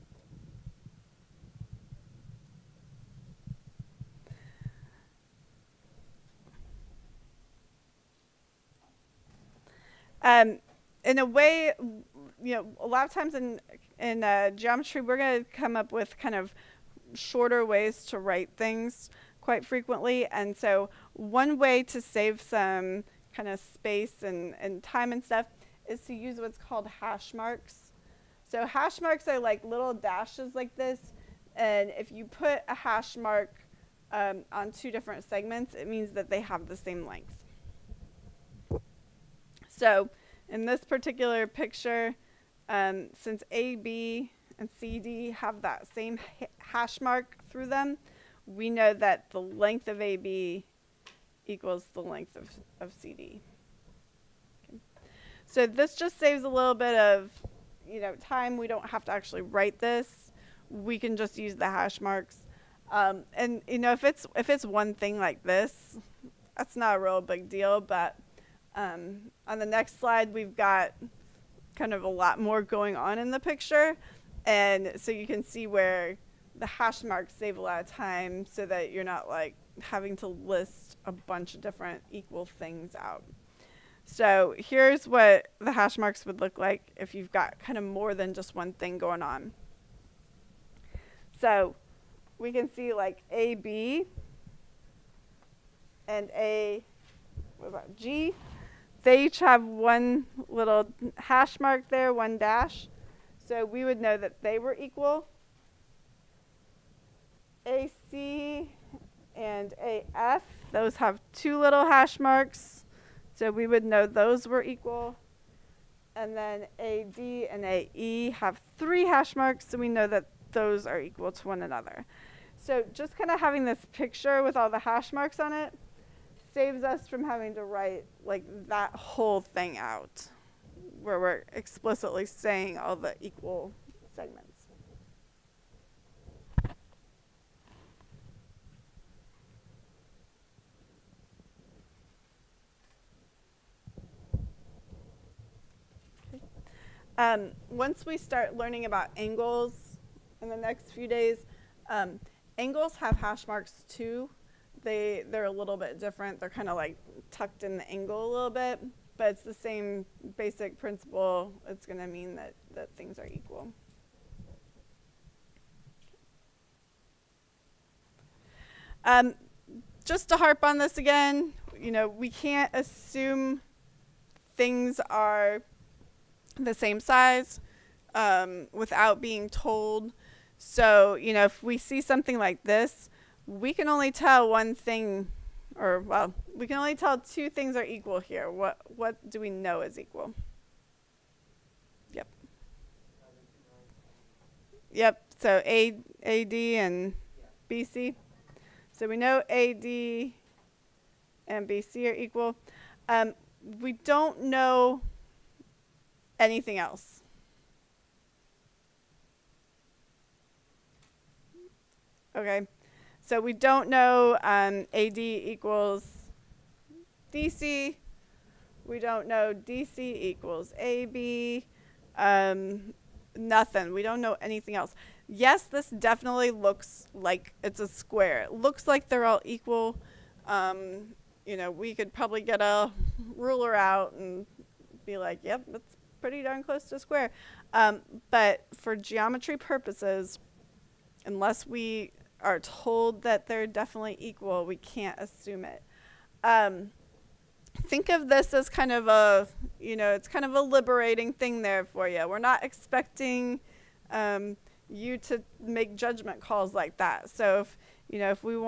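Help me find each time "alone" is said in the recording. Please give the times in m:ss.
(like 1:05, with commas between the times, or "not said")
not said.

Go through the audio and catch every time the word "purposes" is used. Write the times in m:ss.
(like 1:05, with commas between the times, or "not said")
3:59.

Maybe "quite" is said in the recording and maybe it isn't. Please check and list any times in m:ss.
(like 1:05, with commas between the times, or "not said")
0:19.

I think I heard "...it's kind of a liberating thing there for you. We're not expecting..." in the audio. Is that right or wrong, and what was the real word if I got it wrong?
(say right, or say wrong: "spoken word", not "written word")
right.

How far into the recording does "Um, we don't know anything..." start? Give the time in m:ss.
3:23.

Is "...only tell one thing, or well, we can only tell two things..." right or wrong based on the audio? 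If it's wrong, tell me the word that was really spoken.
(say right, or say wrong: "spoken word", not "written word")
right.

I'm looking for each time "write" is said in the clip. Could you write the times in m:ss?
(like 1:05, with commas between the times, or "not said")
0:18, 0:59, 2:07.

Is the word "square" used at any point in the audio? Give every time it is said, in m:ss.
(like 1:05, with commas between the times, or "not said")
3:47, 3:56.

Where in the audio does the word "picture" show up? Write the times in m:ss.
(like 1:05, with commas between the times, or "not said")
0:41, 1:13, 2:03.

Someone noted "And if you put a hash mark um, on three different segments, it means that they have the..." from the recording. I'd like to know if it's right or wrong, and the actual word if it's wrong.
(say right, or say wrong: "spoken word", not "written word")
wrong: "two", not "three".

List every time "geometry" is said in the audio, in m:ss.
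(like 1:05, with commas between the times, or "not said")
0:14, 3:58.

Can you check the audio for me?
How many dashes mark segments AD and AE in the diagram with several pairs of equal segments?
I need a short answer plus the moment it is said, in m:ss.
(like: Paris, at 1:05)
3, at 1:58.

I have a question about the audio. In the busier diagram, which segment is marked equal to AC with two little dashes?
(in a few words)
AF.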